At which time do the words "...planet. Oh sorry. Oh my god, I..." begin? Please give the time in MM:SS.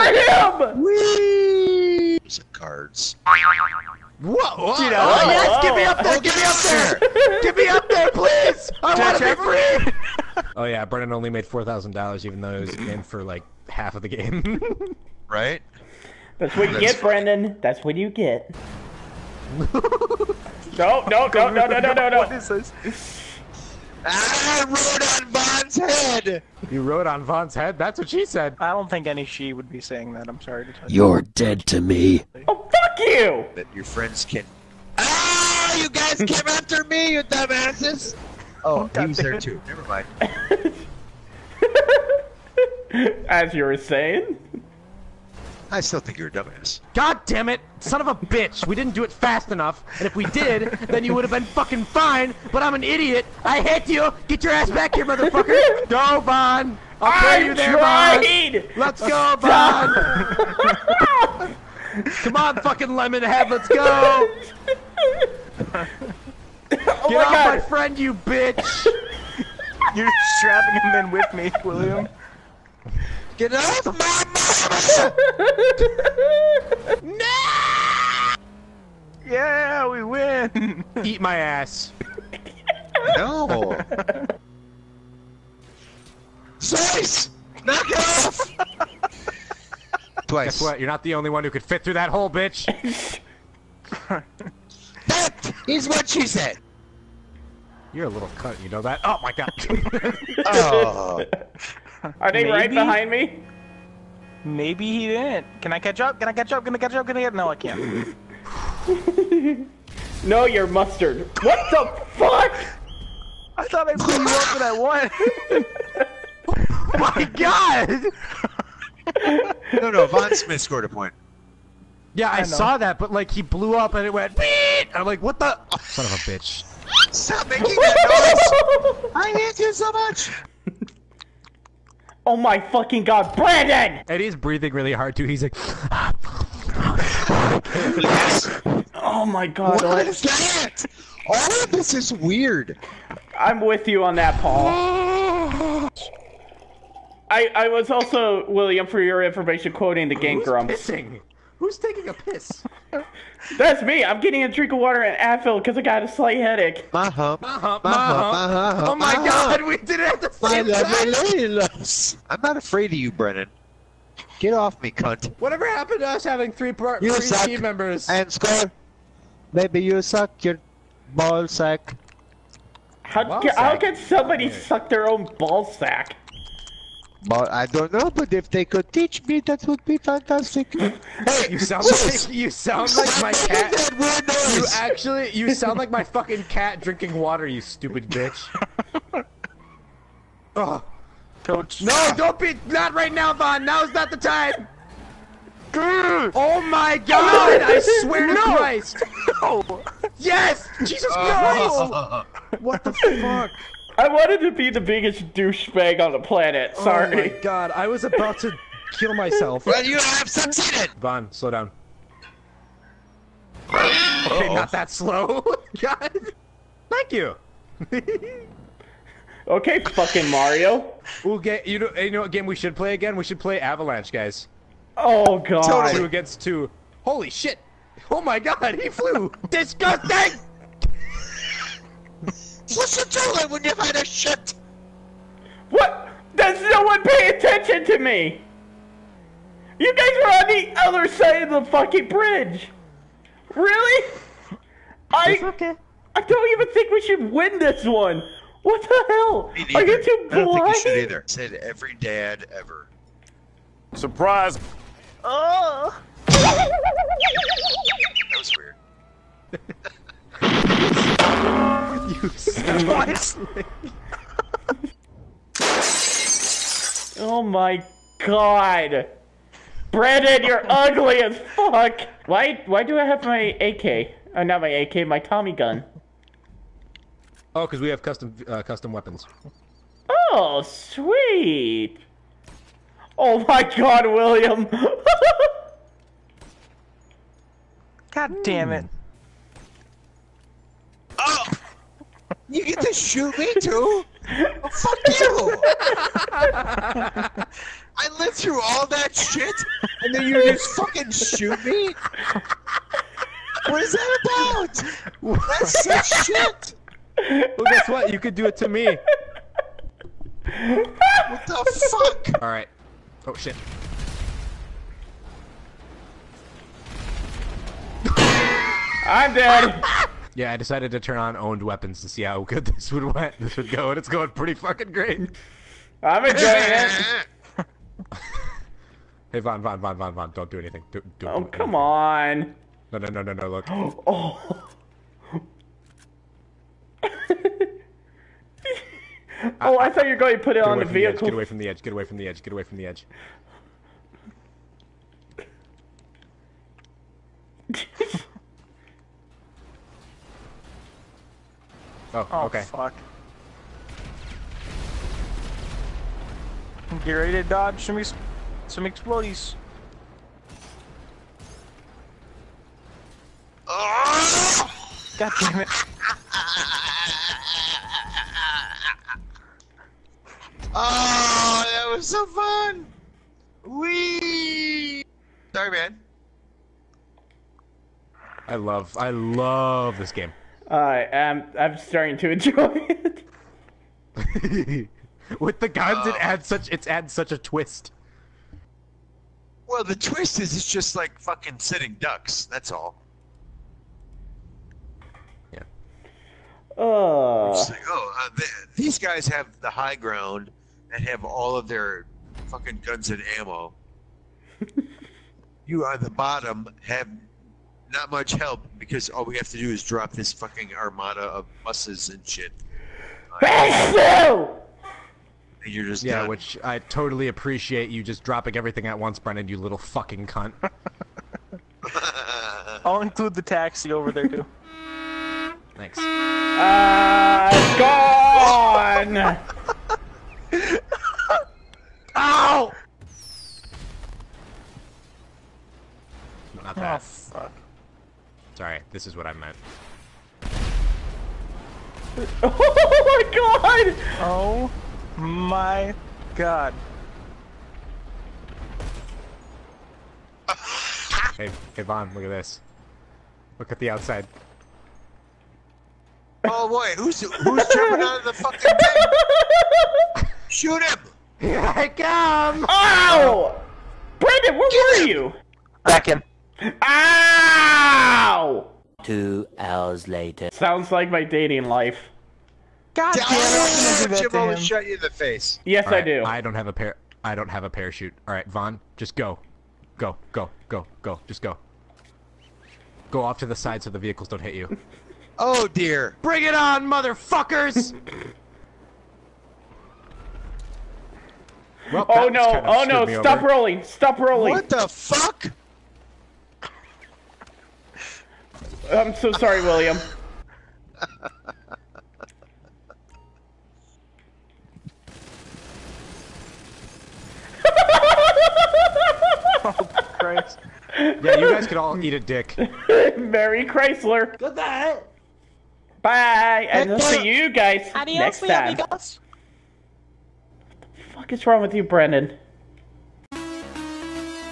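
03:26.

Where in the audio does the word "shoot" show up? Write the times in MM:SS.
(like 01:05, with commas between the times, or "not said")
04:52, 05:01, 07:40.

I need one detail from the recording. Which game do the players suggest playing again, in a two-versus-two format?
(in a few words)
Avalanche.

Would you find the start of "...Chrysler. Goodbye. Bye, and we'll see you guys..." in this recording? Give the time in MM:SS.
08:33.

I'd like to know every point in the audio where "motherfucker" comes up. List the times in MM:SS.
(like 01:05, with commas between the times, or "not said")
00:55, 08:06.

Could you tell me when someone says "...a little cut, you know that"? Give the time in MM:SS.
01:38.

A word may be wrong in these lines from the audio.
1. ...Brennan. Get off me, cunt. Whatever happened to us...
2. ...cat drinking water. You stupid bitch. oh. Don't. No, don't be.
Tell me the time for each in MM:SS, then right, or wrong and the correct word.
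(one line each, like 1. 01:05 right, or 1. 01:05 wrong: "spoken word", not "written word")
1. 02:43 right
2. 03:06 right.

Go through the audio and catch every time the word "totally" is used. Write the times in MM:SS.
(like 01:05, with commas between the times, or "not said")
03:45, 06:56.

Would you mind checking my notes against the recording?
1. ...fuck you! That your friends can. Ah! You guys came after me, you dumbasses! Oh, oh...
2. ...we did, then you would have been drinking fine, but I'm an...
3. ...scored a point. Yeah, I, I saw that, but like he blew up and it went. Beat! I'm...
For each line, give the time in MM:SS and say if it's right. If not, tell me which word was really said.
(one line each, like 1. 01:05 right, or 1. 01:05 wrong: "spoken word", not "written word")
1. 00:32 right
2. 00:50 wrong: "fucking", not "drinking"
3. 02:00 right.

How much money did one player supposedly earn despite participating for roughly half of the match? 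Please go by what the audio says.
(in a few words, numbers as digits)
$4,000.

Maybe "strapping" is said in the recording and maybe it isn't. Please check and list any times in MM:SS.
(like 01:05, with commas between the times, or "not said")
01:10.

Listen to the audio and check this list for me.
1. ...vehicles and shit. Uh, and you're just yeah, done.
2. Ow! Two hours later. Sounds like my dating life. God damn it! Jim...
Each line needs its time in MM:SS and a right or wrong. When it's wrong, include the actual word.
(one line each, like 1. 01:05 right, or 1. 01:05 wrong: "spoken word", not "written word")
1. 06:51 wrong: "buses", not "vehicles"
2. 07:46 right.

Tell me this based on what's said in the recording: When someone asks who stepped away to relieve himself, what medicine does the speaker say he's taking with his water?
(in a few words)
Advil.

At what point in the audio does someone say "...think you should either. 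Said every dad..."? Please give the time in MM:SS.
04:10.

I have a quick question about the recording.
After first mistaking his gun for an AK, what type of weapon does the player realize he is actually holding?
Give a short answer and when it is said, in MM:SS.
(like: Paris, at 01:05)
Tommy gun, at 04:35.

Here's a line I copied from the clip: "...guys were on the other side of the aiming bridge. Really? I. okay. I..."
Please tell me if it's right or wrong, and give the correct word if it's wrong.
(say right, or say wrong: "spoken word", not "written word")
wrong: "fucking", not "aiming".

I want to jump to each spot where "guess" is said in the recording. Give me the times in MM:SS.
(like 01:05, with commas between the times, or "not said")
01:30, 05:07.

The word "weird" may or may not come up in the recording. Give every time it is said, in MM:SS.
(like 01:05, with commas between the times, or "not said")
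02:22, 04:18.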